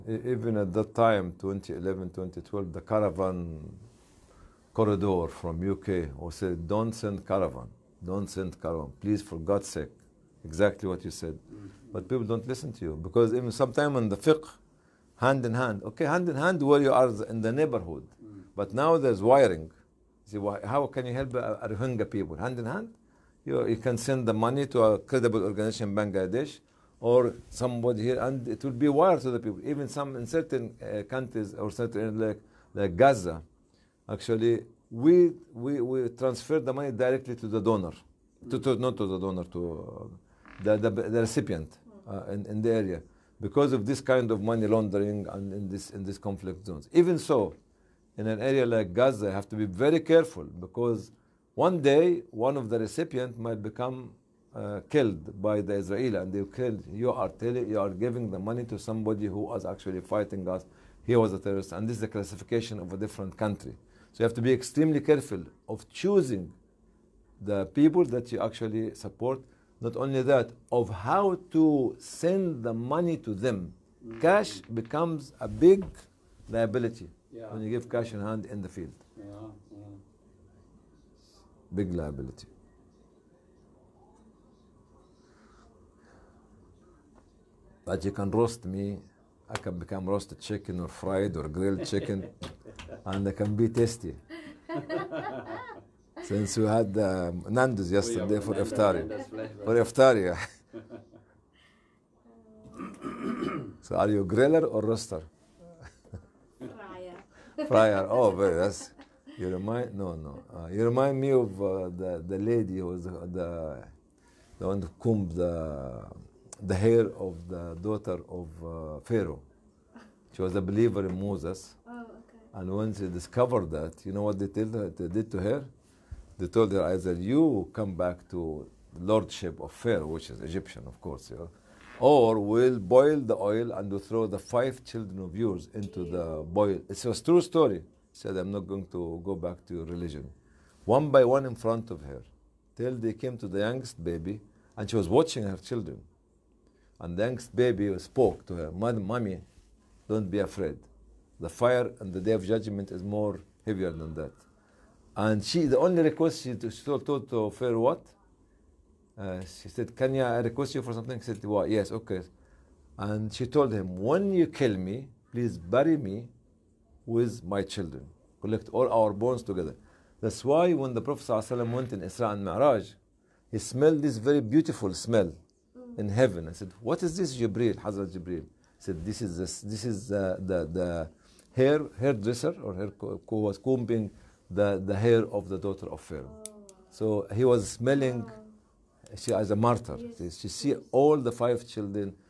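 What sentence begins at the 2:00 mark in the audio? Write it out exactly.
She was a believer in Moses.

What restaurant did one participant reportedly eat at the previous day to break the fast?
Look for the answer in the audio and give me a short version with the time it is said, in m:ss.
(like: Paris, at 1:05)
Nando's, at 1:37.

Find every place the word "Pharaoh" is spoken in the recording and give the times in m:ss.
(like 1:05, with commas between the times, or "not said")
1:59, 2:09, 2:37, 3:06.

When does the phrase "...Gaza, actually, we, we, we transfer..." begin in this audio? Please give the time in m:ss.
0:32.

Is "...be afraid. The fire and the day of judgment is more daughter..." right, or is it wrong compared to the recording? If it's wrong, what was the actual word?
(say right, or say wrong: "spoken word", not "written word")
wrong: "heavier", not "daughter".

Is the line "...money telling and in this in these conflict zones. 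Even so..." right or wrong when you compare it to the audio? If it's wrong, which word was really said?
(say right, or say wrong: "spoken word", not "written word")
wrong: "laundering", not "telling".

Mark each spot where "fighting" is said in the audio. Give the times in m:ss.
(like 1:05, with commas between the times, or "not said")
1:00.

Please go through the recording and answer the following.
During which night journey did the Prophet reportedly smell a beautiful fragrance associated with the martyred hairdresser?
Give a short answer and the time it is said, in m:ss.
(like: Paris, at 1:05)
Isra and Mi'raj, at 2:52.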